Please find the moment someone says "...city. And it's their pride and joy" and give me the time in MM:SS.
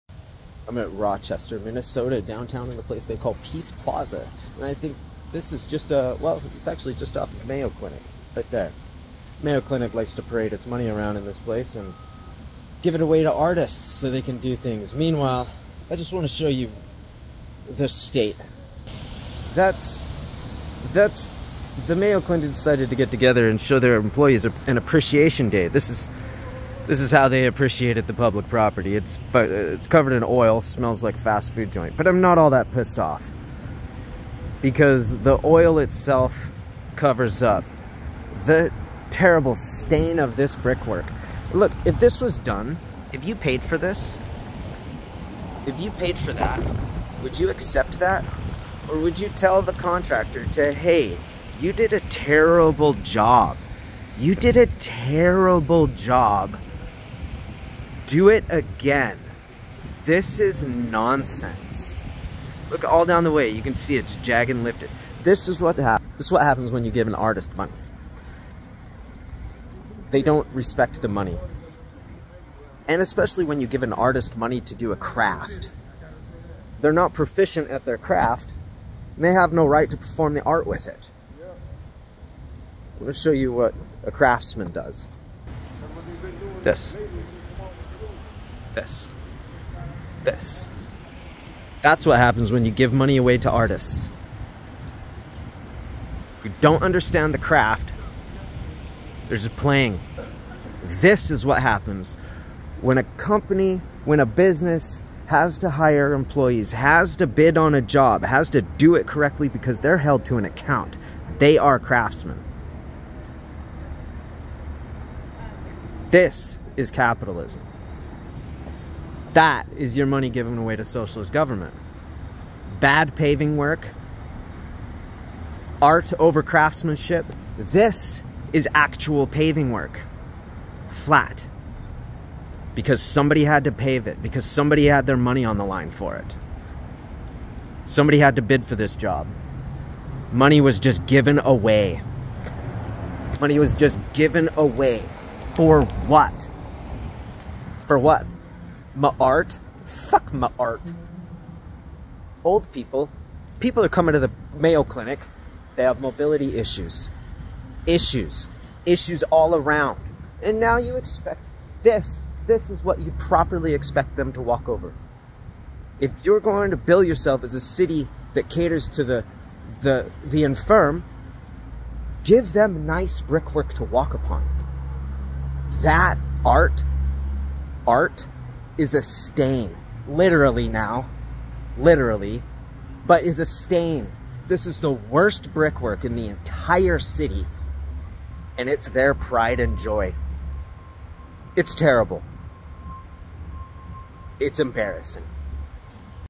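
03:06.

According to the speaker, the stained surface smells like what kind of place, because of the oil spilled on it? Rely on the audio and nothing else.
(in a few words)
fast food joint.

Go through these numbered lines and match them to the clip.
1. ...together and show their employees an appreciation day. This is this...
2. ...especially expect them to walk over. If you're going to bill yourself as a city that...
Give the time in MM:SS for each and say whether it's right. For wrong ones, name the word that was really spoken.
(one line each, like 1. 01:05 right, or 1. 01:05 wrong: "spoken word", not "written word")
1. 00:23 right
2. 02:43 wrong: "properly", not "especially".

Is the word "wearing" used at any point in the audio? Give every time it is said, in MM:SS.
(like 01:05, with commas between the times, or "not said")
not said.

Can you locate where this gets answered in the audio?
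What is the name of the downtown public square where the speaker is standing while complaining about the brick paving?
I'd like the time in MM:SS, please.
00:03.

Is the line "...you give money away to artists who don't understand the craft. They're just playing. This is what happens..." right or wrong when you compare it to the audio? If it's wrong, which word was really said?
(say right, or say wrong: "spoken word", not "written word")
right.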